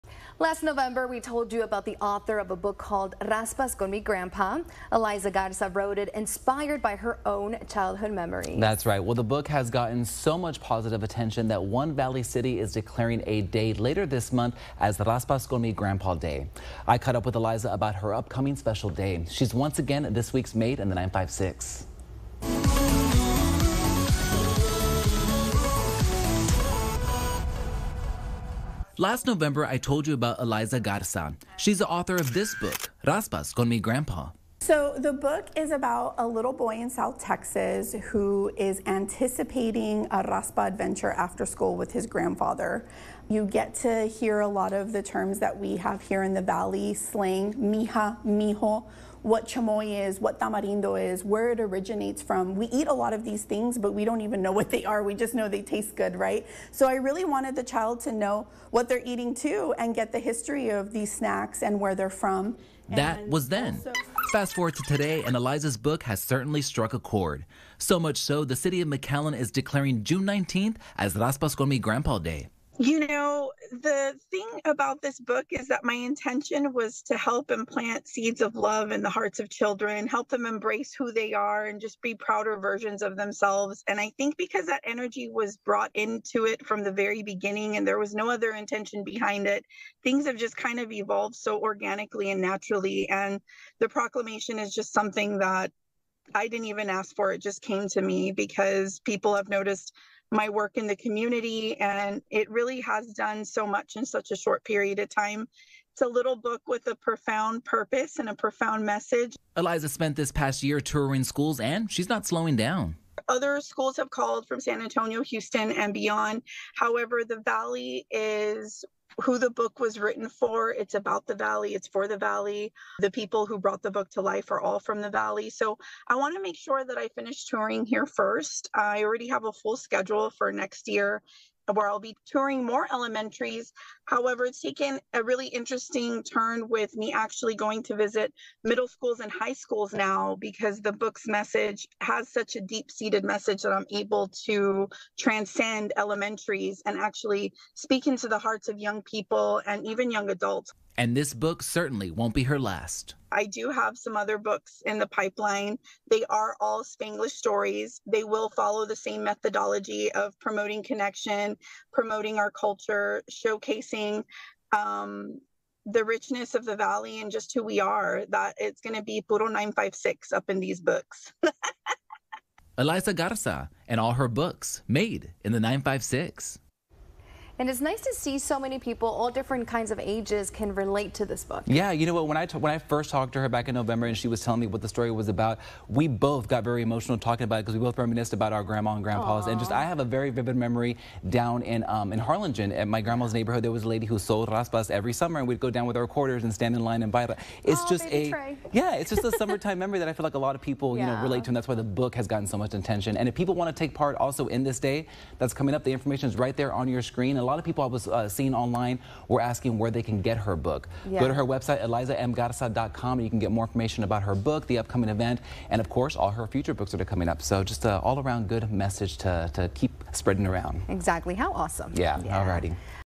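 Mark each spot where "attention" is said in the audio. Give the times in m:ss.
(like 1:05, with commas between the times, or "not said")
0:11, 3:22.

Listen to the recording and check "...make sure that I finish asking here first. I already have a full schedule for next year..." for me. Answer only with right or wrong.
wrong.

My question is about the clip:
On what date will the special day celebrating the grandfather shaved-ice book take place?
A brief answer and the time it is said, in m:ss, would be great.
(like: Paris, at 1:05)
June 19th, at 1:10.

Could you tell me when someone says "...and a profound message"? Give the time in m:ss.
1:48.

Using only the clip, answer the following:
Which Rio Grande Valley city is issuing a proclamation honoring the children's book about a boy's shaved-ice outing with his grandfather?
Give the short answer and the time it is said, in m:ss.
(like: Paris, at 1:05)
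McAllen, at 1:08.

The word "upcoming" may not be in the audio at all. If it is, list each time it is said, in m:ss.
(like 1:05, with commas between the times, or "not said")
0:18, 3:34.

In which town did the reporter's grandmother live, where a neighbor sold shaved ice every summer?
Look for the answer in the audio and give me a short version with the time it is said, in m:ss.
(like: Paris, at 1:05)
Harlingen, at 3:12.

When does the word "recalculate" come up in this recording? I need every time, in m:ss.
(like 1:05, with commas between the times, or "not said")
not said.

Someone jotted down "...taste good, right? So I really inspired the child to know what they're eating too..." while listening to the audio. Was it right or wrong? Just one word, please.
wrong.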